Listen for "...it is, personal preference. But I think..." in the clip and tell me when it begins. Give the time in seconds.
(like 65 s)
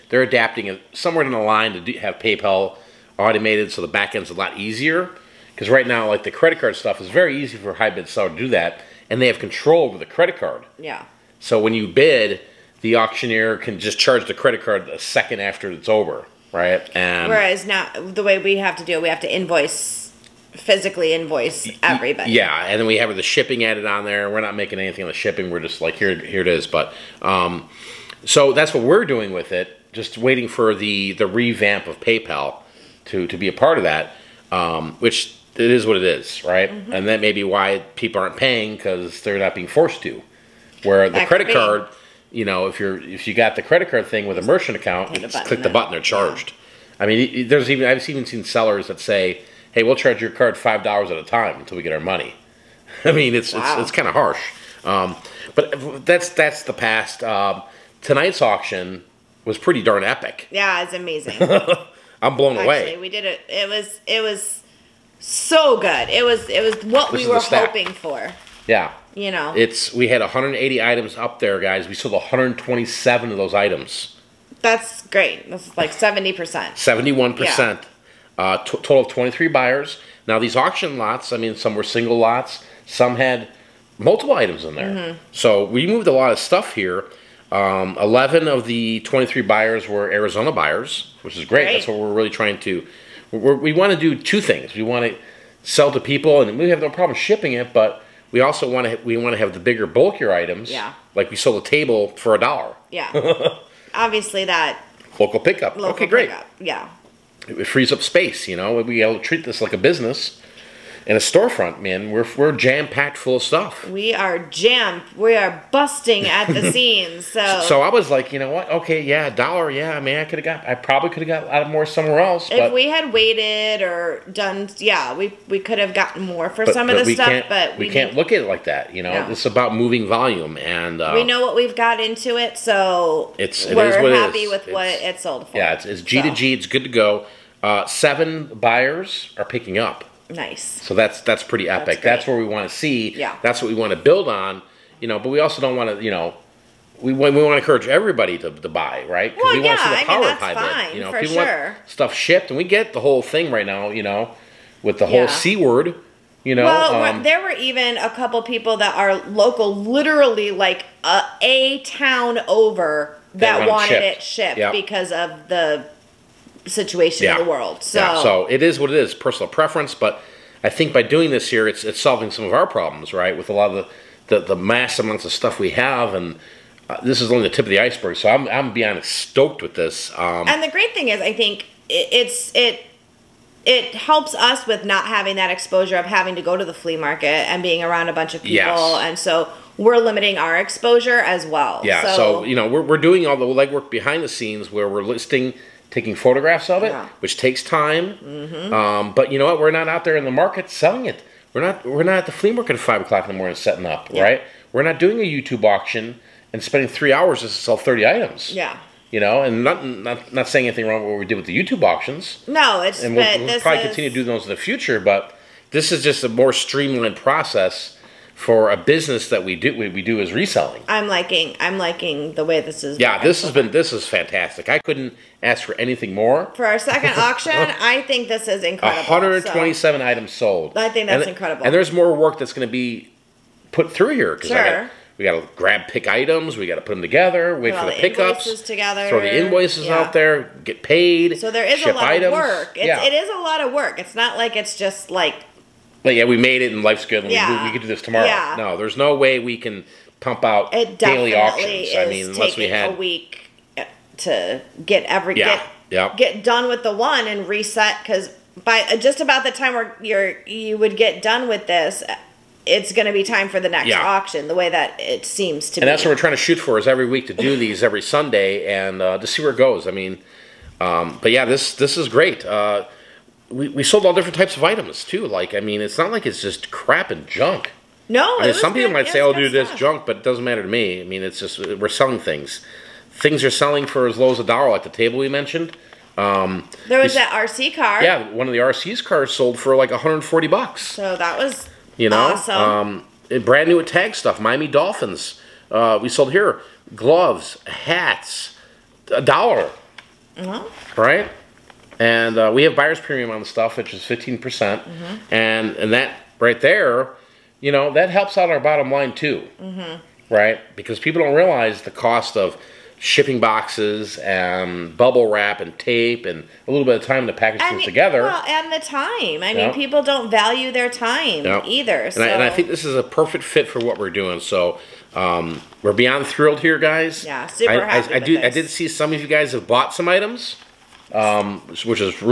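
168 s.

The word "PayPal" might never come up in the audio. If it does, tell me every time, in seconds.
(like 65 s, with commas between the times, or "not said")
2 s, 31 s.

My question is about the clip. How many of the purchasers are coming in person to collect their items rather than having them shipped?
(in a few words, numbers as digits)
7.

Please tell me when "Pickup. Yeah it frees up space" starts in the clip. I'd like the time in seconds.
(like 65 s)
106 s.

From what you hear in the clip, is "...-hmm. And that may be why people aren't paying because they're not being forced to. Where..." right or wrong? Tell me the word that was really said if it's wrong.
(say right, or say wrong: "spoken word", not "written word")
right.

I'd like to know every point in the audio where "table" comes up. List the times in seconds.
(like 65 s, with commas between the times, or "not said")
101 s, 284 s.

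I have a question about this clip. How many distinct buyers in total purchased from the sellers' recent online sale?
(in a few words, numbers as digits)
23.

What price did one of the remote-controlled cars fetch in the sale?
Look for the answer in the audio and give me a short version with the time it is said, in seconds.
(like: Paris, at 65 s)
$140, at 289 s.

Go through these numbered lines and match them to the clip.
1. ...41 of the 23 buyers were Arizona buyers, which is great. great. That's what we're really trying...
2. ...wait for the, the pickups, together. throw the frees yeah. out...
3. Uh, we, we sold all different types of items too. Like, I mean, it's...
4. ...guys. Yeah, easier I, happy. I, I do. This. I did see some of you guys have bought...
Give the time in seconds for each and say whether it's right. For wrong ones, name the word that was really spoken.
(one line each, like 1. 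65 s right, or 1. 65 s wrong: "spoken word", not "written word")
1. 88 s wrong: "11", not "41"
2. 237 s wrong: "invoices", not "frees"
3. 272 s right
4. 326 s wrong: "super", not "easier".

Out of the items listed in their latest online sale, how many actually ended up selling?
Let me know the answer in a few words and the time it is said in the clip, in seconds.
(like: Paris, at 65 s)
127, at 71 s.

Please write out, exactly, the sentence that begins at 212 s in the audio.
No, it's and we'll, we'll probably is...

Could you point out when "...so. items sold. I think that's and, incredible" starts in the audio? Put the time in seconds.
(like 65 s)
230 s.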